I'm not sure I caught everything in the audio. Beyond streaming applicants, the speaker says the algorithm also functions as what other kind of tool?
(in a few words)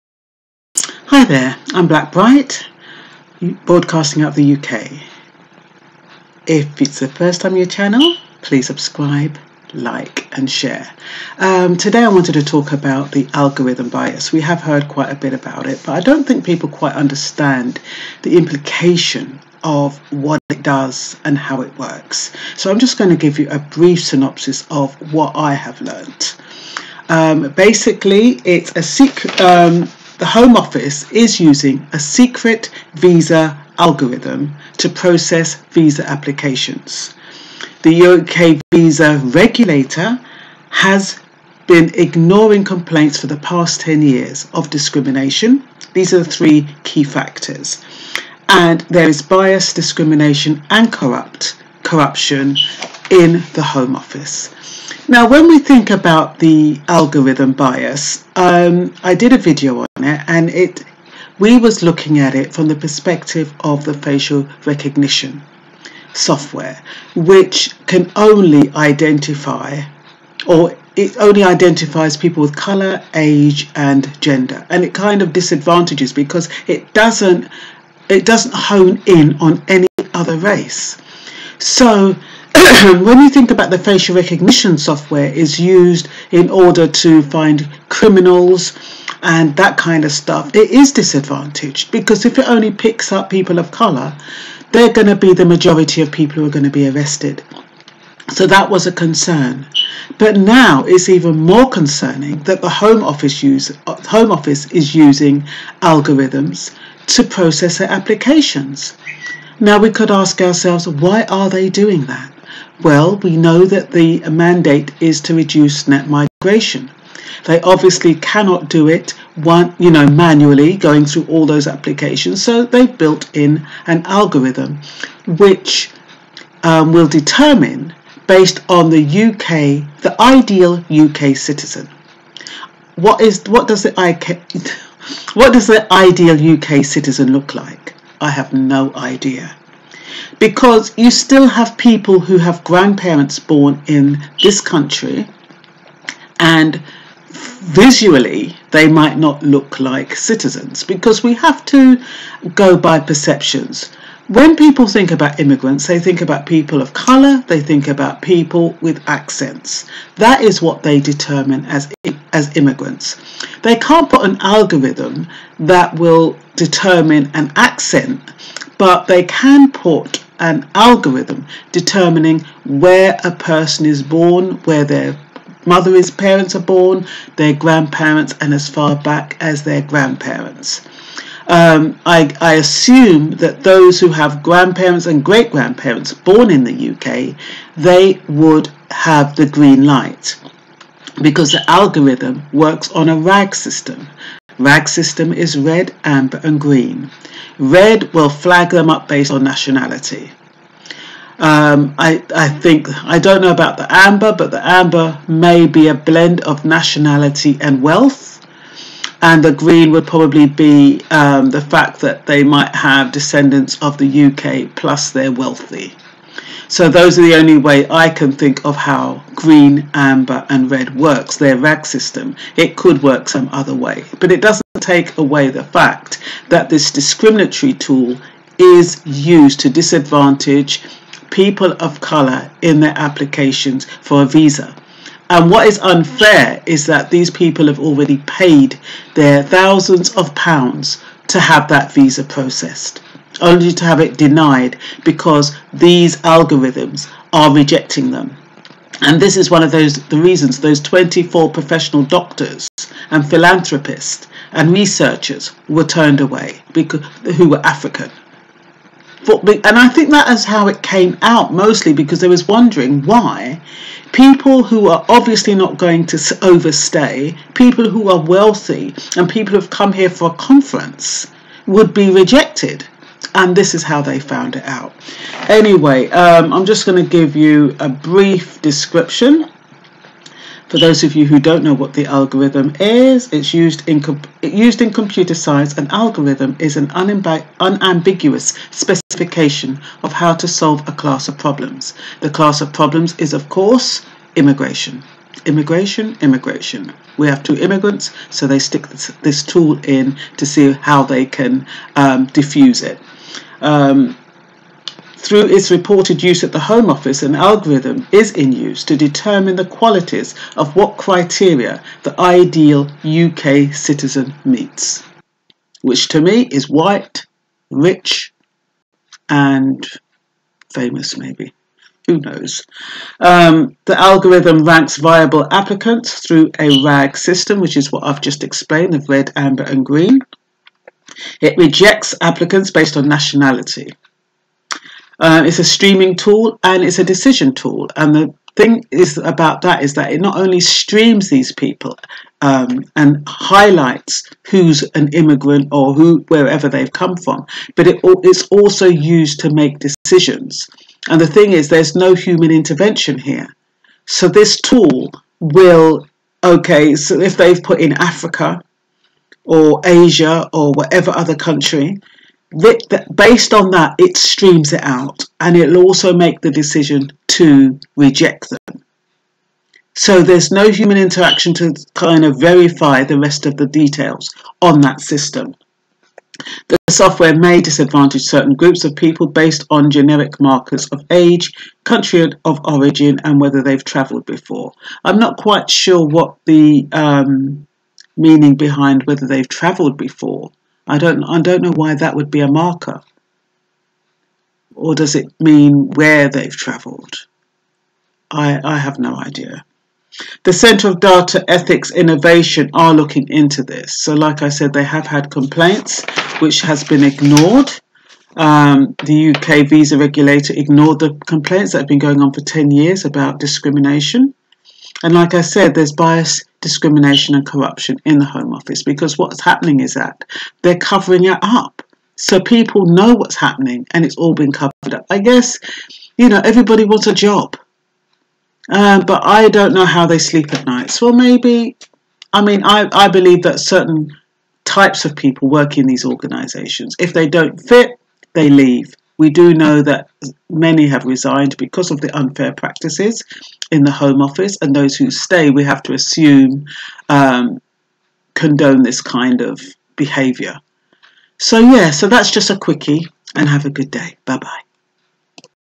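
decision tool.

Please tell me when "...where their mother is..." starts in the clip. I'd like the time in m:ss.
2:54.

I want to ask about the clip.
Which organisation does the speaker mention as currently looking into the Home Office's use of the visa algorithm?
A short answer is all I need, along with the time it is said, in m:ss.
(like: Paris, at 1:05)
Centre of Data Ethics Innovation, at 6:40.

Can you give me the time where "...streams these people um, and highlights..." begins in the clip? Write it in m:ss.
5:40.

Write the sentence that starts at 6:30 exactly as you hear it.
I don't, I don't know why that would be a marker.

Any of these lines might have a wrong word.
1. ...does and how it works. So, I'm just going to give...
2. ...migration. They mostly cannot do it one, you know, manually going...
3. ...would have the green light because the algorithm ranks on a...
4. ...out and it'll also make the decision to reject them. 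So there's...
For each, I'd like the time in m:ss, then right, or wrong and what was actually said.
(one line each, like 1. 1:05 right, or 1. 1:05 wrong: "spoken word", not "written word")
1. 0:20 right
2. 1:56 wrong: "obviously", not "mostly"
3. 3:08 wrong: "works", not "ranks"
4. 6:04 right.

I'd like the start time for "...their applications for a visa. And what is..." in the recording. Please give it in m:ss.
3:52.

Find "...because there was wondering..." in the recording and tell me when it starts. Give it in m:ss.
4:21.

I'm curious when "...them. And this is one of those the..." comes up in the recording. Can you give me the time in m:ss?
4:08.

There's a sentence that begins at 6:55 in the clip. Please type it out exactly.
And like I said, there's bias discrimination and corruption in the Home Office because what's happening is that they're covering it up.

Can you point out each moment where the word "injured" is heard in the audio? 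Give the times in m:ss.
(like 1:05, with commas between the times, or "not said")
not said.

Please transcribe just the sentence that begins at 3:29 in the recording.
And the green would probably be um, the fact that they might have descendants of the UK plus they're wealthy.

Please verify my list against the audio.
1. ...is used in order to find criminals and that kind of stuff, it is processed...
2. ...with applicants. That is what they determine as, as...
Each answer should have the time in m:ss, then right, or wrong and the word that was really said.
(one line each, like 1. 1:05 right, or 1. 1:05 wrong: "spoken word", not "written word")
1. 1:25 wrong: "disadvantaged", not "processed"
2. 2:38 wrong: "accents", not "applicants".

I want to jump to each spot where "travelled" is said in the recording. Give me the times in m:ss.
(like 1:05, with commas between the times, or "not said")
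6:23, 6:29, 6:36.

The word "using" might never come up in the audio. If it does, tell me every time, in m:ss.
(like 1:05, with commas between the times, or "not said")
0:31, 1:44.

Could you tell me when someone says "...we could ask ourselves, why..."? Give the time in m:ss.
1:49.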